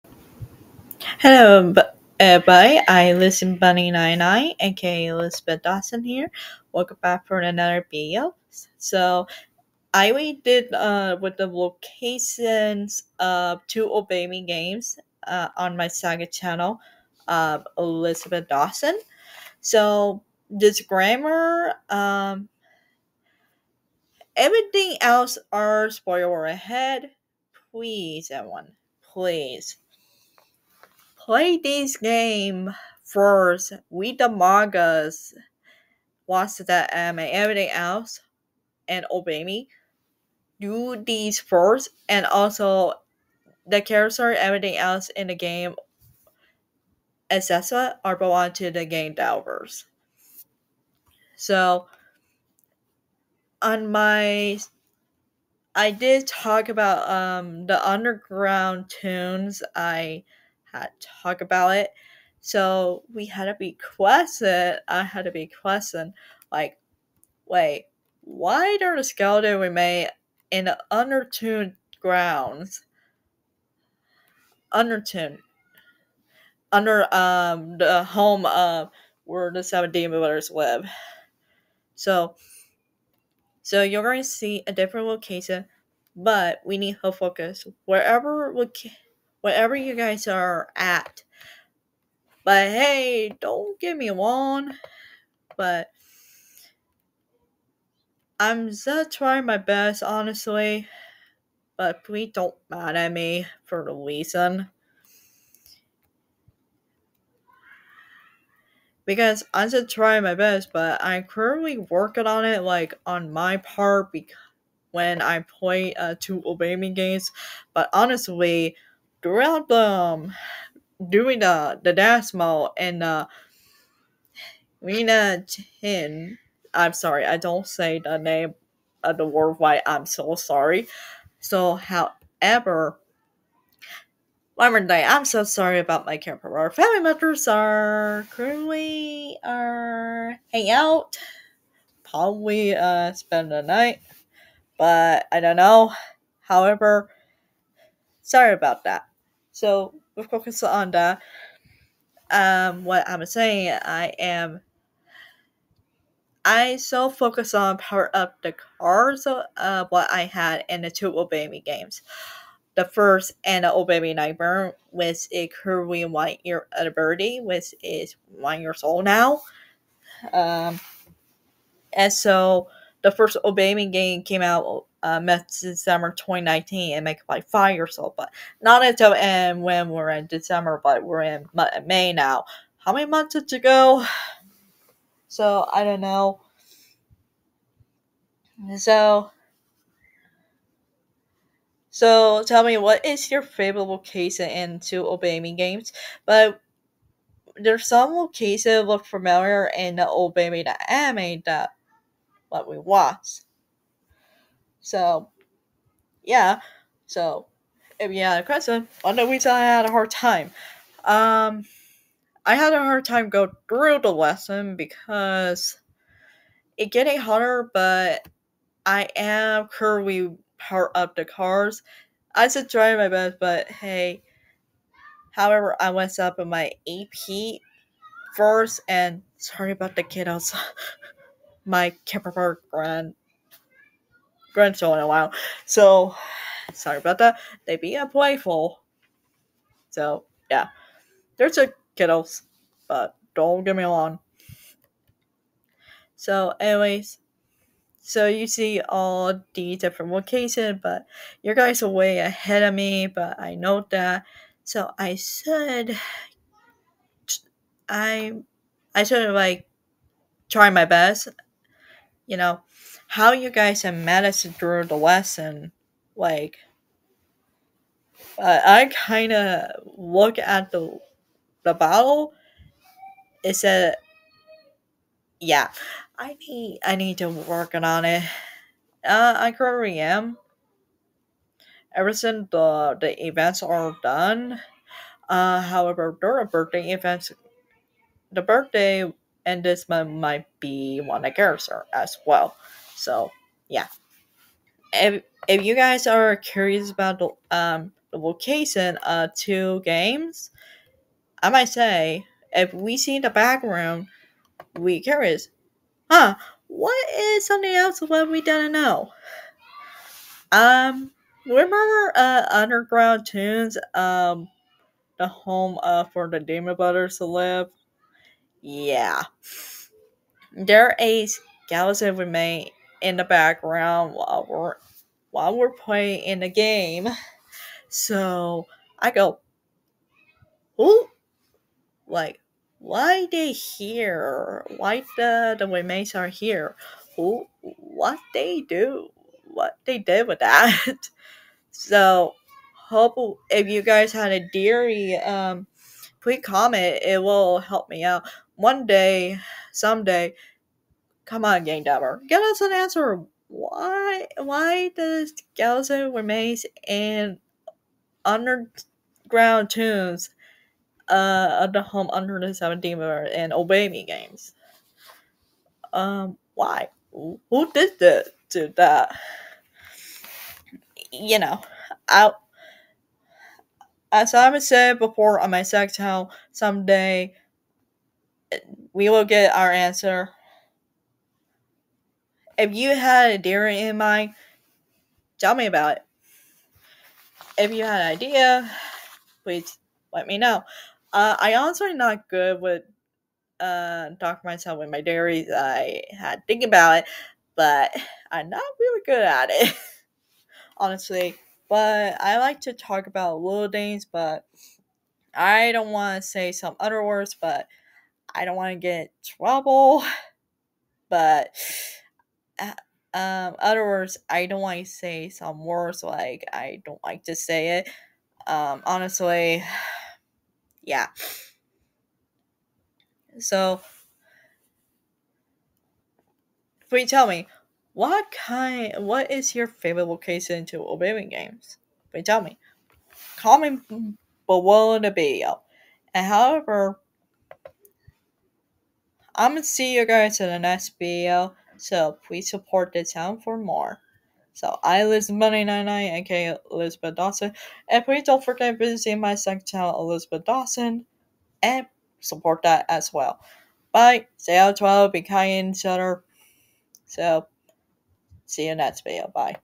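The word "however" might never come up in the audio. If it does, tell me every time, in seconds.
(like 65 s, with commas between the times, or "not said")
131 s, 146 s, 225 s, 285 s, 436 s.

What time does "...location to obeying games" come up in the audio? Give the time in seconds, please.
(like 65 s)
430 s.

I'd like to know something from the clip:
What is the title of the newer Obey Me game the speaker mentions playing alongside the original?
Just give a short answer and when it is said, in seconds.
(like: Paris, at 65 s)
Obey Me Nightmare, at 163 s.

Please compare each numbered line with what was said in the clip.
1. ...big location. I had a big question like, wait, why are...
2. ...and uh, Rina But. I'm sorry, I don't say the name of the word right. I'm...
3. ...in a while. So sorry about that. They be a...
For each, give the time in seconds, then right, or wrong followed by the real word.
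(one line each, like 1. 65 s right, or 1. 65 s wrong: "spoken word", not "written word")
1. 63 s wrong: "question", not "location"
2. 122 s wrong: "Chen", not "But"
3. 234 s right.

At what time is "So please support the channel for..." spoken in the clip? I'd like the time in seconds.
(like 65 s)
441 s.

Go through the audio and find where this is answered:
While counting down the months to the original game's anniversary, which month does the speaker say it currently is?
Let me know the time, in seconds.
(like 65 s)
181 s.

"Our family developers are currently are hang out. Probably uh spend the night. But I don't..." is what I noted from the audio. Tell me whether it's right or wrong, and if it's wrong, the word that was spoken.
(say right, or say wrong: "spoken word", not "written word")
wrong: "members", not "developers".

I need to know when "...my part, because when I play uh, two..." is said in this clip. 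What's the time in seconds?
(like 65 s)
113 s.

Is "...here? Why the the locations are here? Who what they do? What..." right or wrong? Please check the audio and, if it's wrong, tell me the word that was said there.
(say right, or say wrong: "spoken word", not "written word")
wrong: "remains", not "locations".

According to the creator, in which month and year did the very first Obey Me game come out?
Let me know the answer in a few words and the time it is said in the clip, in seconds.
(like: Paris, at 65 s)
December 2019, at 175 s.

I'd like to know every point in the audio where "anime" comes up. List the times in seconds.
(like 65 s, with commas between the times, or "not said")
36 s, 200 s.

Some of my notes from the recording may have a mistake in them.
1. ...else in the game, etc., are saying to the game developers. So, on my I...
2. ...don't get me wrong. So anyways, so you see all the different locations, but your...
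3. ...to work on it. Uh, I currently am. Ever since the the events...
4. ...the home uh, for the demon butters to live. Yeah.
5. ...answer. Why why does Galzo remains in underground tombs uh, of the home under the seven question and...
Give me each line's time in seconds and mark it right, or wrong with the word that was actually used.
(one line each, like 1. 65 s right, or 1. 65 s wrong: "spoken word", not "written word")
1. 44 s wrong: "belong", not "saying"
2. 243 s right
3. 277 s right
4. 315 s right
5. 352 s wrong: "demon", not "question".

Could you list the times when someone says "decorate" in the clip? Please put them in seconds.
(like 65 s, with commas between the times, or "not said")
not said.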